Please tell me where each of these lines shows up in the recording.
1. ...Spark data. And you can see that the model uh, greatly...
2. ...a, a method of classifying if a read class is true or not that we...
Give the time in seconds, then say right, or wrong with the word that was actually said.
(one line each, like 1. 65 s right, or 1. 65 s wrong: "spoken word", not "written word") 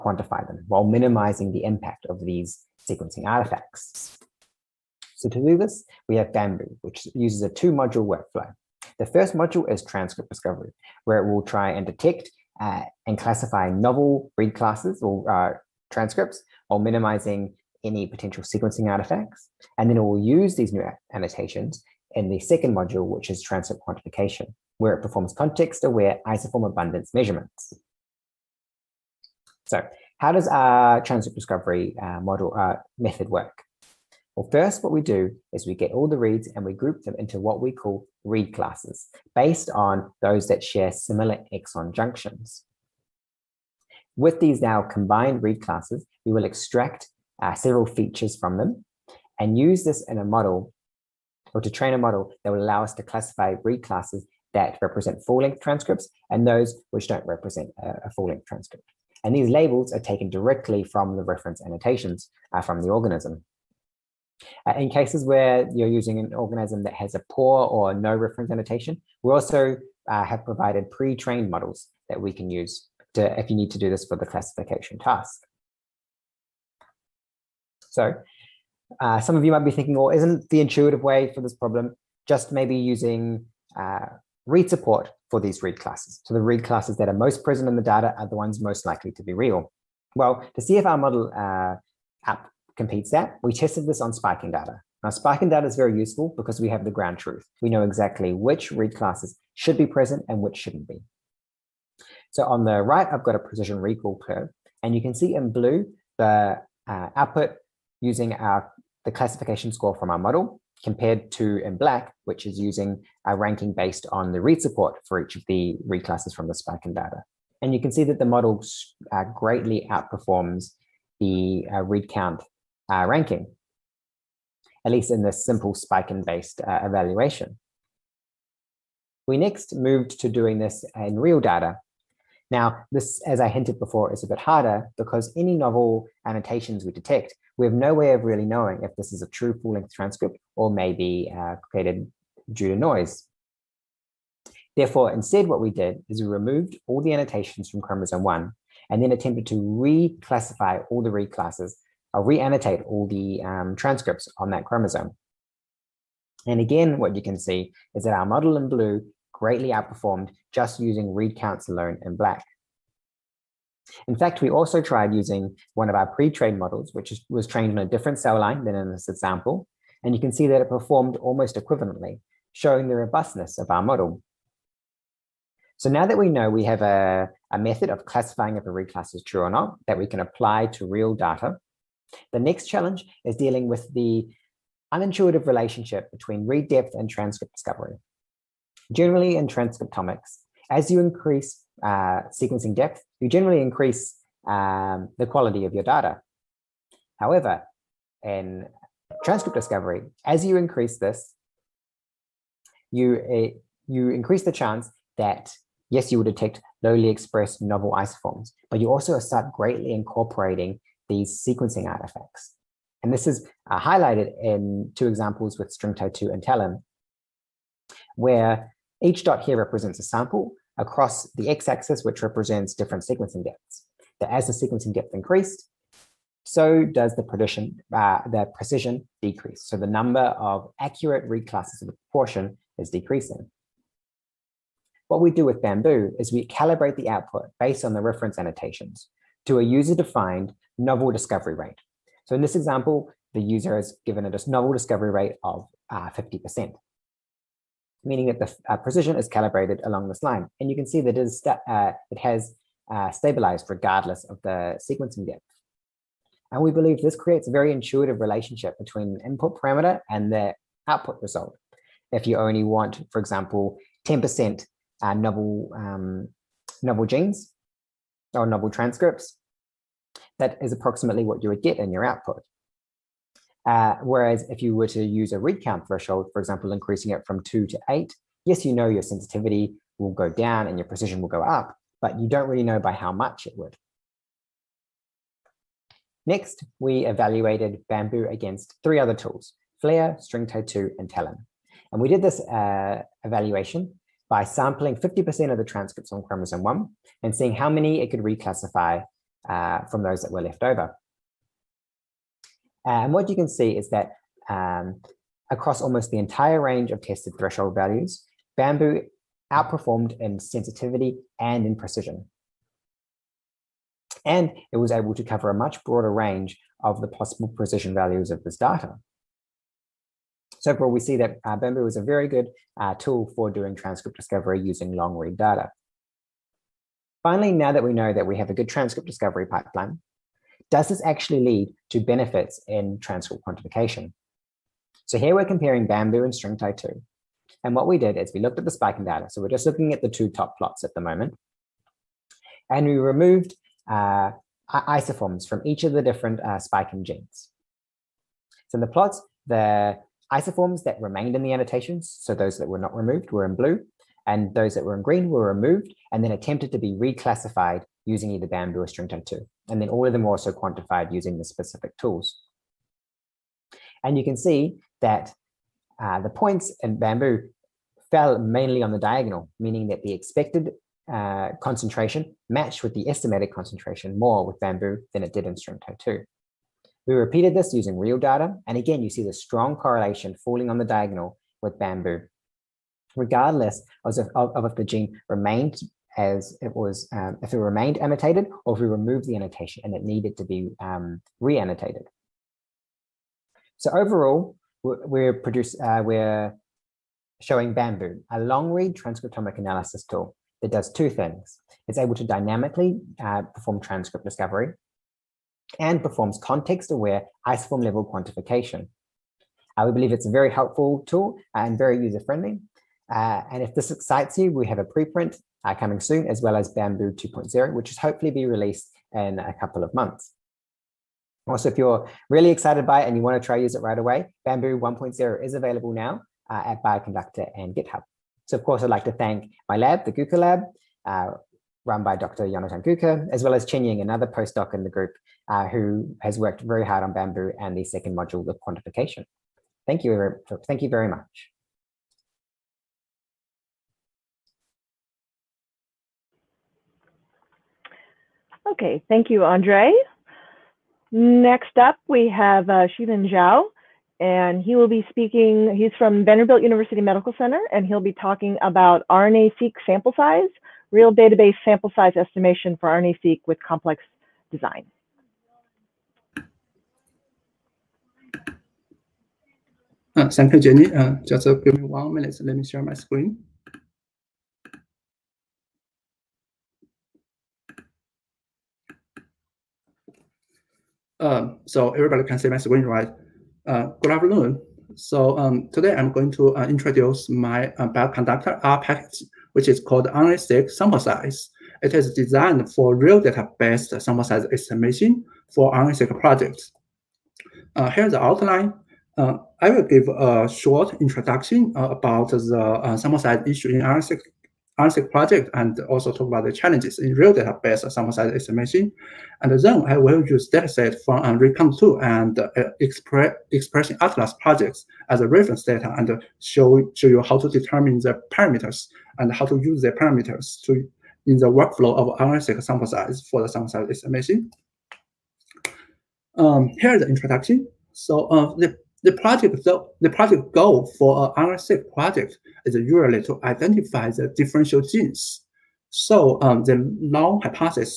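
1. 116 s right
2. 176 s right.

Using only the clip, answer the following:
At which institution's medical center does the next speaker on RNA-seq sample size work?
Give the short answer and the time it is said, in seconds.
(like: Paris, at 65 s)
Vanderbilt University Medical Center, at 456 s.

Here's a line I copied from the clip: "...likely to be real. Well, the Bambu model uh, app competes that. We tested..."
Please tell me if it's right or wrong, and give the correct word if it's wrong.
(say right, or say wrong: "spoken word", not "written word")
wrong: "CFR", not "Bambu".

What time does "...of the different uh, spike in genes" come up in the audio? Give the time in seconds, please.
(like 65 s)
345 s.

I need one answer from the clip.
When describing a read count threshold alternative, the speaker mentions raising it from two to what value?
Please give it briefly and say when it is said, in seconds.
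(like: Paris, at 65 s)
8, at 277 s.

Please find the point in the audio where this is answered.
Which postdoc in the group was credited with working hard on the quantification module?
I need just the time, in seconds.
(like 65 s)
433 s.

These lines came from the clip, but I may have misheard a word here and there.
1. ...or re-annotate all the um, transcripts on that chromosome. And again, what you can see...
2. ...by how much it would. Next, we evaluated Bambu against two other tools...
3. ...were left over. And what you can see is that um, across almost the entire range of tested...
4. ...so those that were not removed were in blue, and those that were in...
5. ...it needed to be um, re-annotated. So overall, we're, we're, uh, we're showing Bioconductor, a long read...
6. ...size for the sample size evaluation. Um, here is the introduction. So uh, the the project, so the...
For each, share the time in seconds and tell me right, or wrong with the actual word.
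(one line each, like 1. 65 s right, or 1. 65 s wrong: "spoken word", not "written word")
1. 152 s right
2. 282 s wrong: "three", not "two"
3. 300 s right
4. 352 s right
5. 389 s wrong: "Bambu", not "Bioconductor"
6. 522 s wrong: "estimation", not "evaluation".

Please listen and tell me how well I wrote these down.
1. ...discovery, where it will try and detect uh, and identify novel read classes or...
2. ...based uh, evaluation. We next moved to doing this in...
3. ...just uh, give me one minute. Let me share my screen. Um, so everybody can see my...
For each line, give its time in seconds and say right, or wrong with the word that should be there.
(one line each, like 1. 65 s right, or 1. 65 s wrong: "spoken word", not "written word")
1. 10 s wrong: "classify", not "identify"
2. 126 s right
3. 471 s right.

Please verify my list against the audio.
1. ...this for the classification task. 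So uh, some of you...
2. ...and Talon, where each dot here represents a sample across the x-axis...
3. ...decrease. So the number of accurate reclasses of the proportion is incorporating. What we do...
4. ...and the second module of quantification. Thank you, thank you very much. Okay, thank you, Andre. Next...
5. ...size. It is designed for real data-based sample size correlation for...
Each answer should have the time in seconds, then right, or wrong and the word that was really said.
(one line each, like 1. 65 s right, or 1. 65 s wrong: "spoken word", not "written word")
1. 73 s right
2. 216 s right
3. 229 s wrong: "decreasing", not "incorporating"
4. 437 s right
5. 490 s wrong: "estimation", not "correlation".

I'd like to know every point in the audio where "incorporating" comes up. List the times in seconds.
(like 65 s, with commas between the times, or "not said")
209 s.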